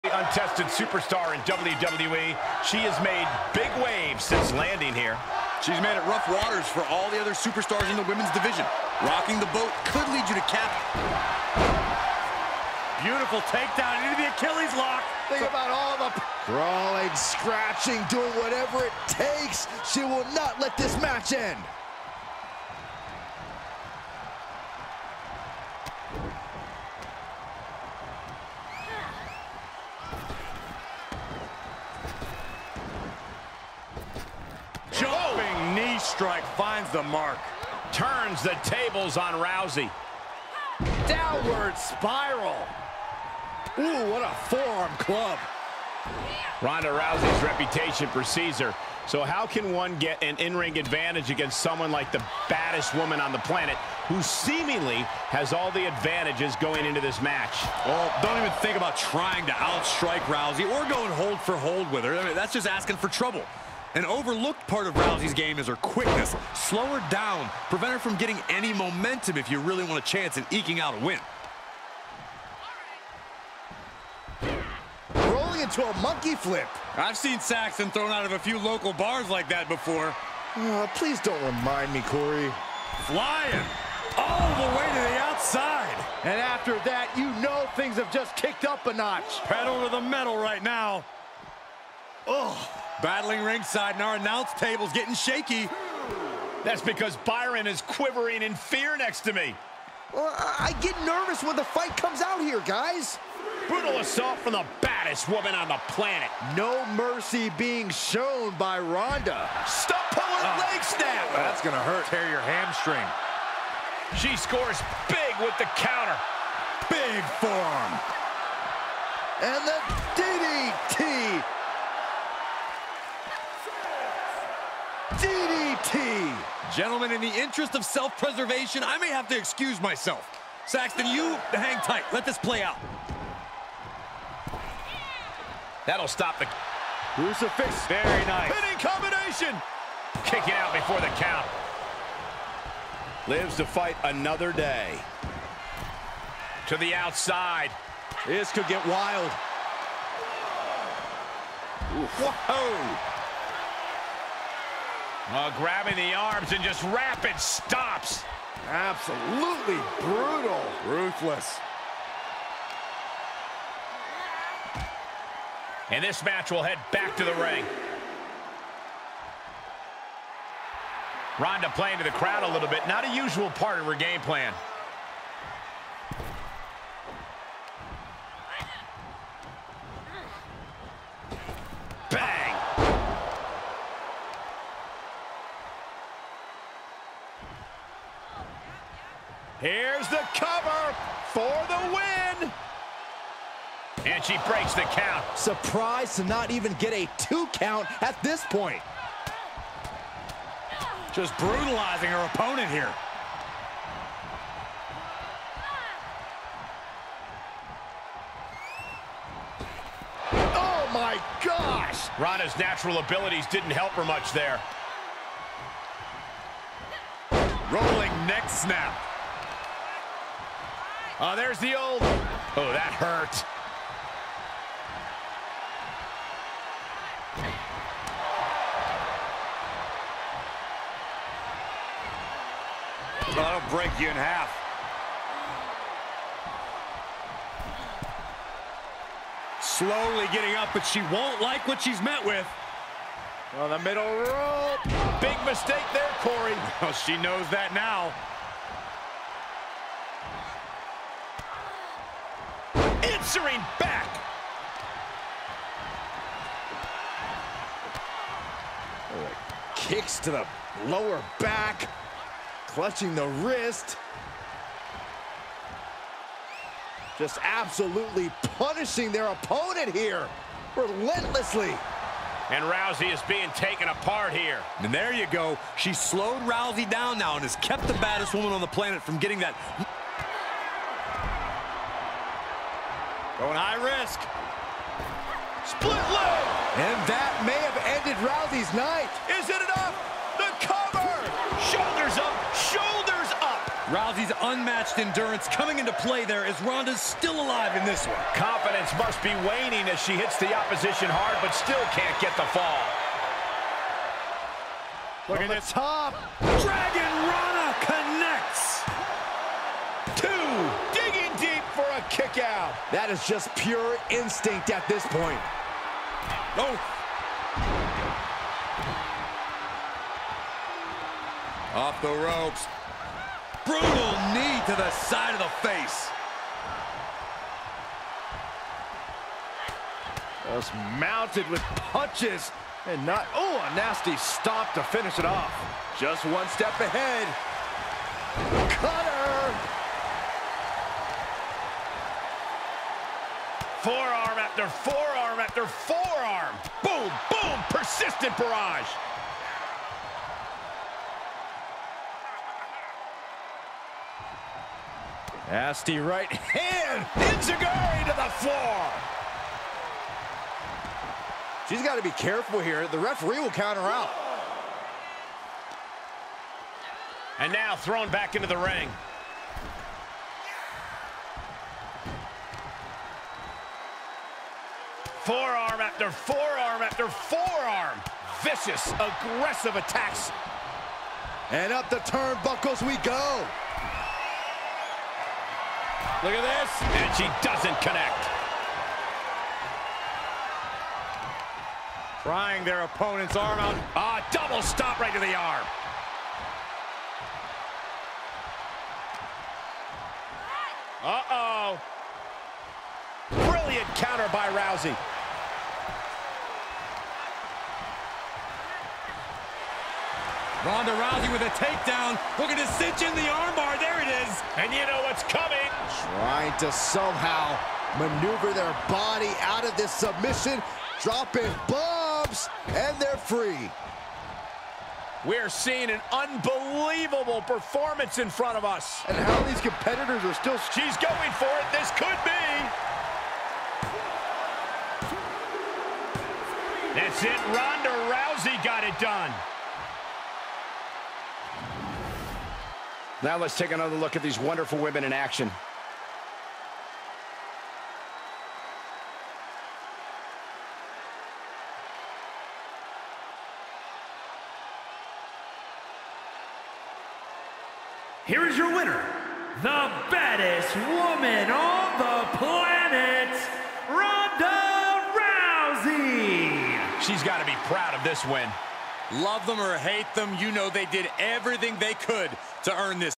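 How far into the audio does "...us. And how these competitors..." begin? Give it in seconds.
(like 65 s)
428 s.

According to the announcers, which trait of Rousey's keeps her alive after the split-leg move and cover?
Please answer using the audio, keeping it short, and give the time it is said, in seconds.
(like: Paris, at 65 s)
unmatched endurance, at 294 s.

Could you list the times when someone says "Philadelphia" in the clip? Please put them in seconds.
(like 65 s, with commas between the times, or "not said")
not said.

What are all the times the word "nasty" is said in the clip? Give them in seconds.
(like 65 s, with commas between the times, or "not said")
333 s, 355 s.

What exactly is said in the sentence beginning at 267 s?
Just absolutely punishing their opponent here, relentlessly.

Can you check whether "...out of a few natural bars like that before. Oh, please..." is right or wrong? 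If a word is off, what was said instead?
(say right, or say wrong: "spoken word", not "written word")
wrong: "local", not "natural".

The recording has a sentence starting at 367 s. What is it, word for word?
And now thrown back into the ring.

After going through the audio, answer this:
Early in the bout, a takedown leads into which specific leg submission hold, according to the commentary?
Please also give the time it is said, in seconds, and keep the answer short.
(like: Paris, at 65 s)
Achilles lock, at 14 s.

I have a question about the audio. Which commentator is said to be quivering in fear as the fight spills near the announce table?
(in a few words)
Byron.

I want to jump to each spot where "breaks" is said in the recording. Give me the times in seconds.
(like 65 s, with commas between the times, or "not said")
194 s, 233 s.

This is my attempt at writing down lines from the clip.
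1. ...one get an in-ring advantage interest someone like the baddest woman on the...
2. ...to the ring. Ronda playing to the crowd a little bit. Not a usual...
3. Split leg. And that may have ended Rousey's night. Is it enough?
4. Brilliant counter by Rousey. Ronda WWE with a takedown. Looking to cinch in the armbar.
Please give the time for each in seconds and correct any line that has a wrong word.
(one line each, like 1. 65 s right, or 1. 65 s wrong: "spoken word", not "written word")
1. 49 s wrong: "against", not "interest"
2. 167 s right
3. 285 s right
4. 403 s wrong: "Rousey", not "WWE".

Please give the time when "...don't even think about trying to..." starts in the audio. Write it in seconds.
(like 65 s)
58 s.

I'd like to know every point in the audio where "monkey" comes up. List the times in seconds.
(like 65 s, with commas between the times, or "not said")
75 s.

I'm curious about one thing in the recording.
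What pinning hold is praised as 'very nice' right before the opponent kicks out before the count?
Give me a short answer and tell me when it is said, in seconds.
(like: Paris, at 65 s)
Crucifix, at 137 s.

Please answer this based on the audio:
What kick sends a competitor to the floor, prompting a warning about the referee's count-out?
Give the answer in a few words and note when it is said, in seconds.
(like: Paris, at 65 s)
Enzuigiri, at 357 s.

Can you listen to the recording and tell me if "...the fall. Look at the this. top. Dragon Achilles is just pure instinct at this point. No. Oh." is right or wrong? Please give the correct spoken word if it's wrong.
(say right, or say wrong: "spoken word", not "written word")
wrong: "That", not "Achilles".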